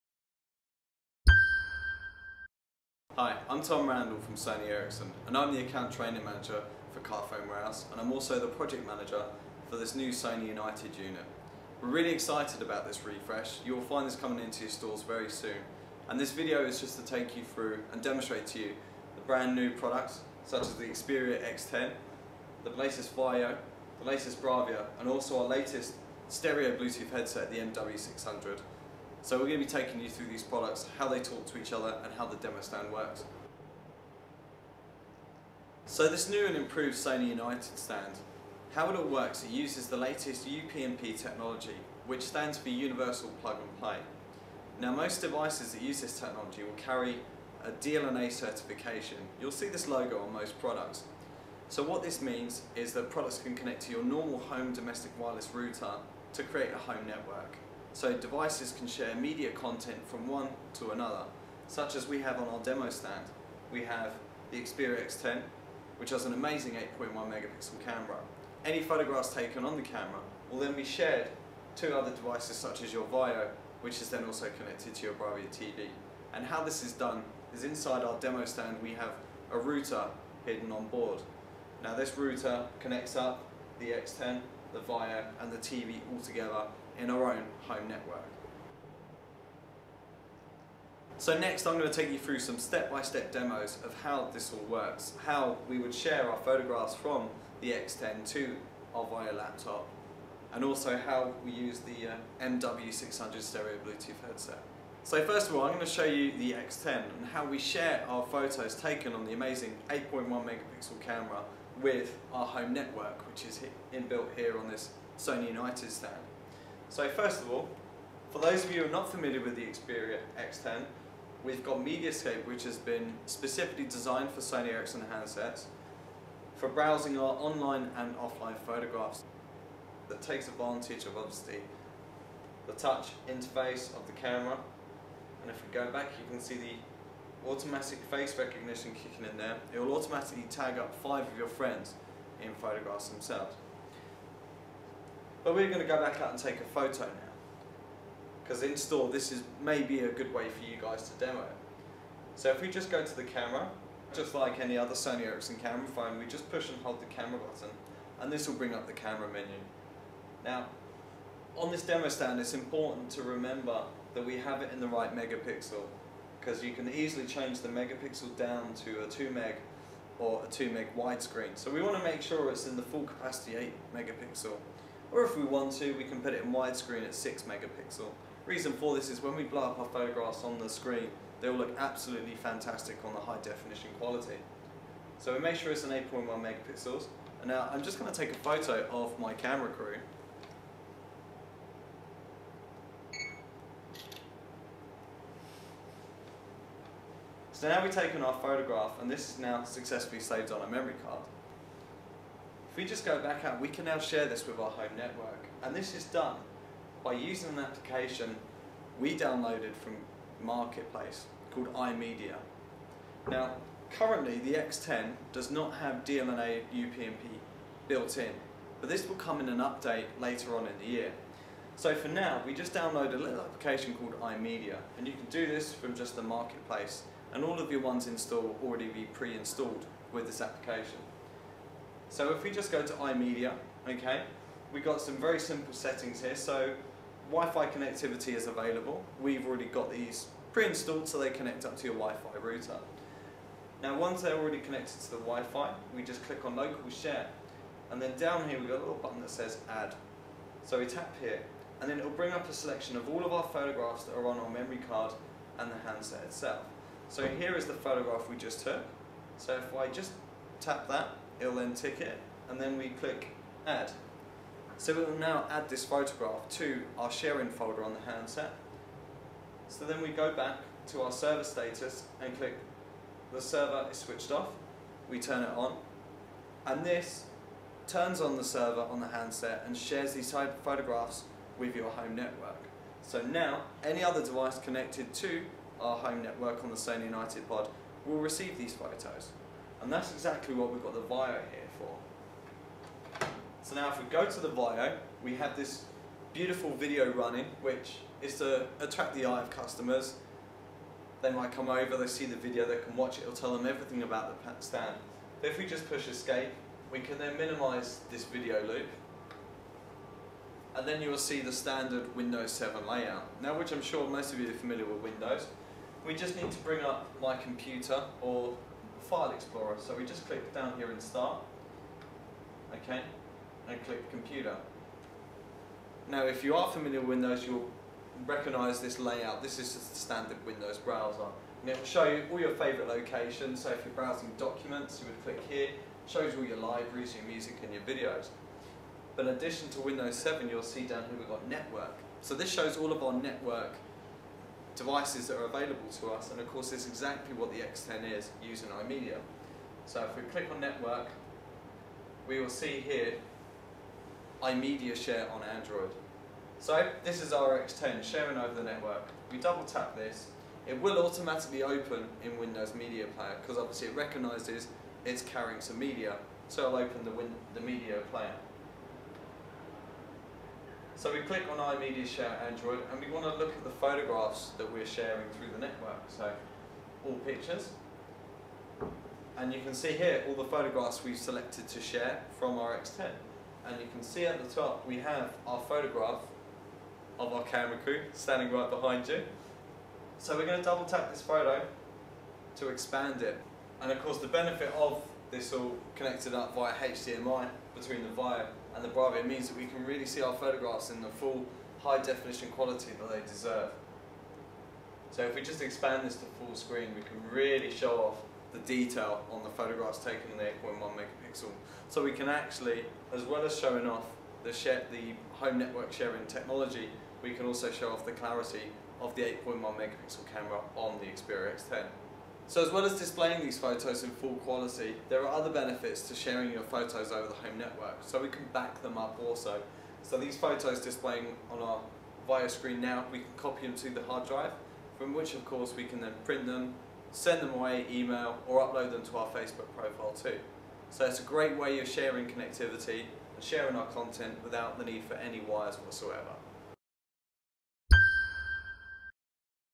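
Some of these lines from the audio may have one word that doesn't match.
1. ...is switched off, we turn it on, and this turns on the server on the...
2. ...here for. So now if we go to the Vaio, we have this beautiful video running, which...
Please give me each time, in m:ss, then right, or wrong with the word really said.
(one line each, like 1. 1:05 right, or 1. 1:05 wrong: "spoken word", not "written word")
1. 4:33 right
2. 4:51 right.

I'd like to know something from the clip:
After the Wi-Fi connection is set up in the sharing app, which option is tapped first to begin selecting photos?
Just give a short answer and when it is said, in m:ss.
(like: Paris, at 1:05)
local share, at 4:06.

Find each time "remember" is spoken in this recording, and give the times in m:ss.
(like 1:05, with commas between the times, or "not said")
2:43.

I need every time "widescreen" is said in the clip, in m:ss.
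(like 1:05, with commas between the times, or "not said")
2:50, 2:56.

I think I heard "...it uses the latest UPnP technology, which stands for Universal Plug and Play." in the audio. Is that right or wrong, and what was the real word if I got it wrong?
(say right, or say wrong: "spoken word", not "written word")
right.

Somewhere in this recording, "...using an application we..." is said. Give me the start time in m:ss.
3:27.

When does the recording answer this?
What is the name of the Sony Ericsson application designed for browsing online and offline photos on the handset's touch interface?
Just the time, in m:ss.
2:01.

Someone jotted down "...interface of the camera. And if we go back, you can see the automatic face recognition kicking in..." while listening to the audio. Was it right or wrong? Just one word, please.
right.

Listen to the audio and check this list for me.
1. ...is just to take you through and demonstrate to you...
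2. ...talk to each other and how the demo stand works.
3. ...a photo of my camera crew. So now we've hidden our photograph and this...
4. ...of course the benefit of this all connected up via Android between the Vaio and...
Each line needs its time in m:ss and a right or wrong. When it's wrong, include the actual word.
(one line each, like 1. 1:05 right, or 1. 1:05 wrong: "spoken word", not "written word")
1. 0:16 right
2. 0:31 right
3. 3:08 wrong: "taken", not "hidden"
4. 6:33 wrong: "HDMI", not "Android".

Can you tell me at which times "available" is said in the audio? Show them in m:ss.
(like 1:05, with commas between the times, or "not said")
3:58, 5:45.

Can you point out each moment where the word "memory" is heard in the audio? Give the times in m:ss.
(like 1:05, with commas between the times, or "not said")
3:20, 4:14.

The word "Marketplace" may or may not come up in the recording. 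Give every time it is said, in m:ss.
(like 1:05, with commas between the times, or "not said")
3:30, 3:46.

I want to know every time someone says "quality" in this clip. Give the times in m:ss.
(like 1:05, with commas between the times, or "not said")
3:03, 6:42, 7:04.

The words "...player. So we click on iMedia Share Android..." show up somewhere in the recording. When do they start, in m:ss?
6:08.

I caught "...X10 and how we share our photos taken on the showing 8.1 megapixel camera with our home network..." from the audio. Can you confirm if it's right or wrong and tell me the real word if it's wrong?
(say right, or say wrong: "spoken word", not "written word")
wrong: "amazing", not "showing".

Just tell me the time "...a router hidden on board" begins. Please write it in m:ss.
1:19.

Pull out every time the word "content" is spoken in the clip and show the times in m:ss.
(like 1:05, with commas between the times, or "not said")
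0:59, 7:23.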